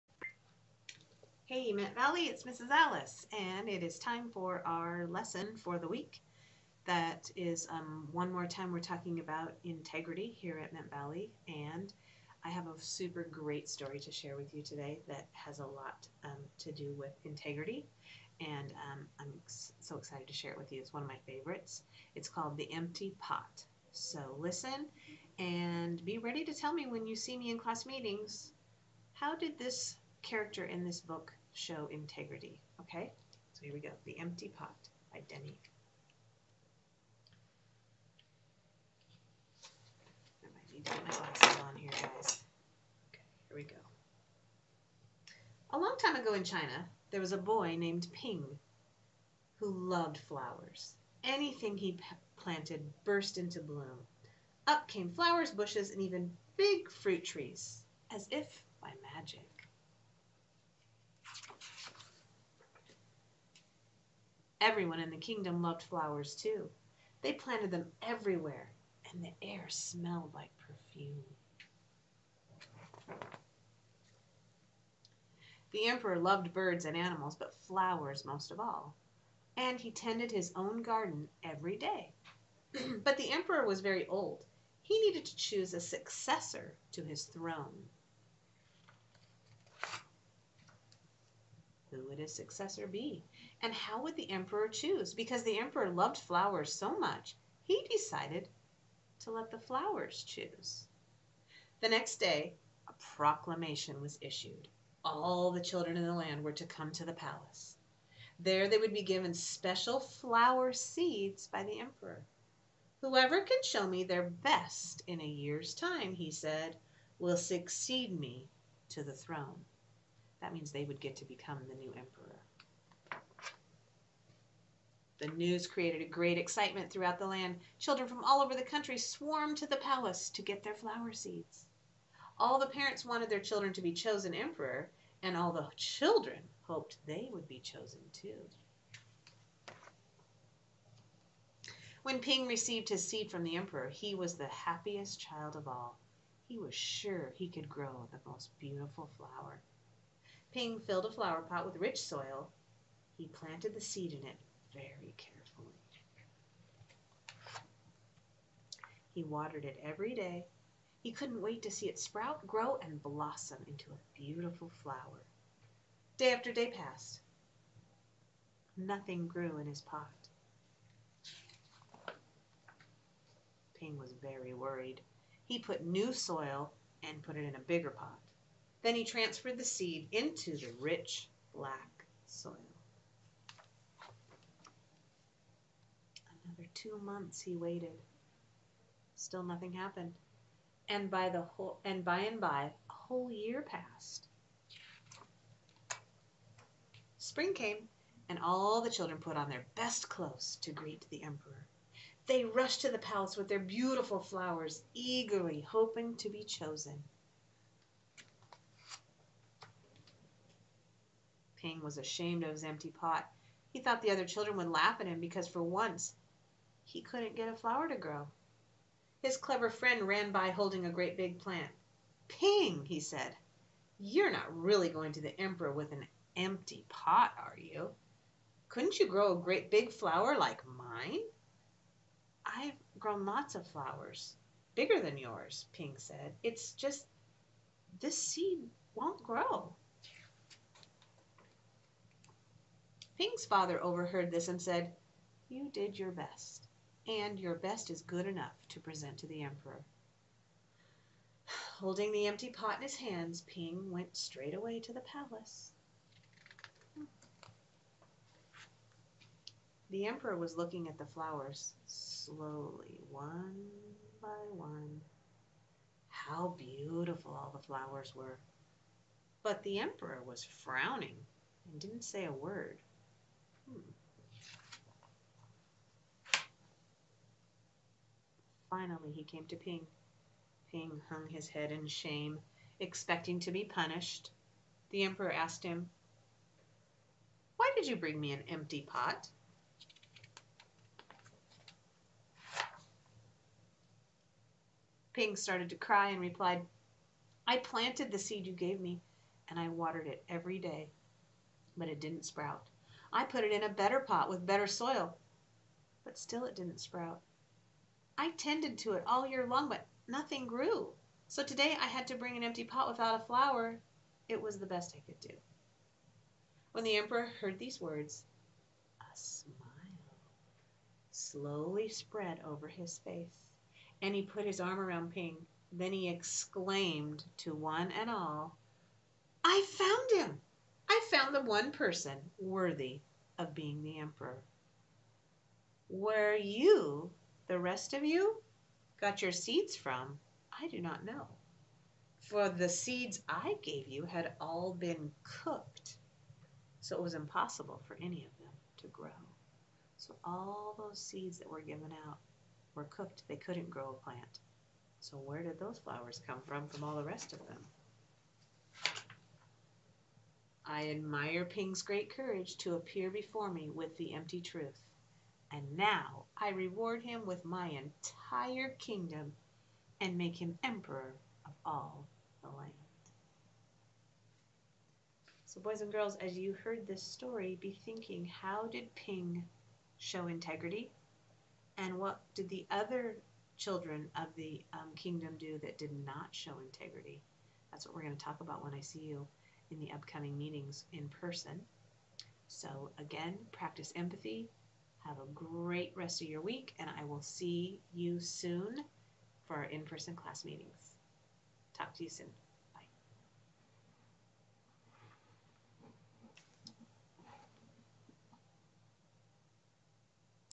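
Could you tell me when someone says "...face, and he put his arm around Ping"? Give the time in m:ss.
5:22.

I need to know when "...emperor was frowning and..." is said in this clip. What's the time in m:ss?
4:29.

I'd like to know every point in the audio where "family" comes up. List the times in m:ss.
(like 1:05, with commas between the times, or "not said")
not said.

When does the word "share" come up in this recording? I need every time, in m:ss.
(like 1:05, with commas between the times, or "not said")
0:14, 0:20.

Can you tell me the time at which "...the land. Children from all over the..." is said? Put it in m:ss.
2:07.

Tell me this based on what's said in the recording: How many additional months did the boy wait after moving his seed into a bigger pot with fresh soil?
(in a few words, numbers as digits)
2.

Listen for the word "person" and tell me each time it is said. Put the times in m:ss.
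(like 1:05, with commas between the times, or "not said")
5:31, 6:31, 6:39.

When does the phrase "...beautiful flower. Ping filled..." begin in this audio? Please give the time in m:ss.
2:28.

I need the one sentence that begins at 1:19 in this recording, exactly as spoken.
And he tended his own garden every day.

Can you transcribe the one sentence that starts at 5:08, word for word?
I tended to it all year long, but nothing grew.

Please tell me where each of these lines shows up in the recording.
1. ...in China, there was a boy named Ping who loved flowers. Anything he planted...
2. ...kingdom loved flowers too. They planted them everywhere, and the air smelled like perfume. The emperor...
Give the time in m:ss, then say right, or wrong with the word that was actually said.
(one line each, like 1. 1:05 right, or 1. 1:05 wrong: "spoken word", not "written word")
1. 0:46 right
2. 1:05 right.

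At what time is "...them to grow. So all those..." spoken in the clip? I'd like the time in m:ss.
5:48.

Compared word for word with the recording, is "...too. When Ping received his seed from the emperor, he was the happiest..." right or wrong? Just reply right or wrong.
right.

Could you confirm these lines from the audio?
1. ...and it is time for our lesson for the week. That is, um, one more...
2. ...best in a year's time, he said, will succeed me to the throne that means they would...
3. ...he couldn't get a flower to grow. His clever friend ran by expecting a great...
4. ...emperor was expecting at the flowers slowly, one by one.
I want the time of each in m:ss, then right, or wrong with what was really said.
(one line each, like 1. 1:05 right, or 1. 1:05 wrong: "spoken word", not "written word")
1. 0:03 right
2. 1:54 right
3. 3:36 wrong: "holding", not "expecting"
4. 4:20 wrong: "looking", not "expecting".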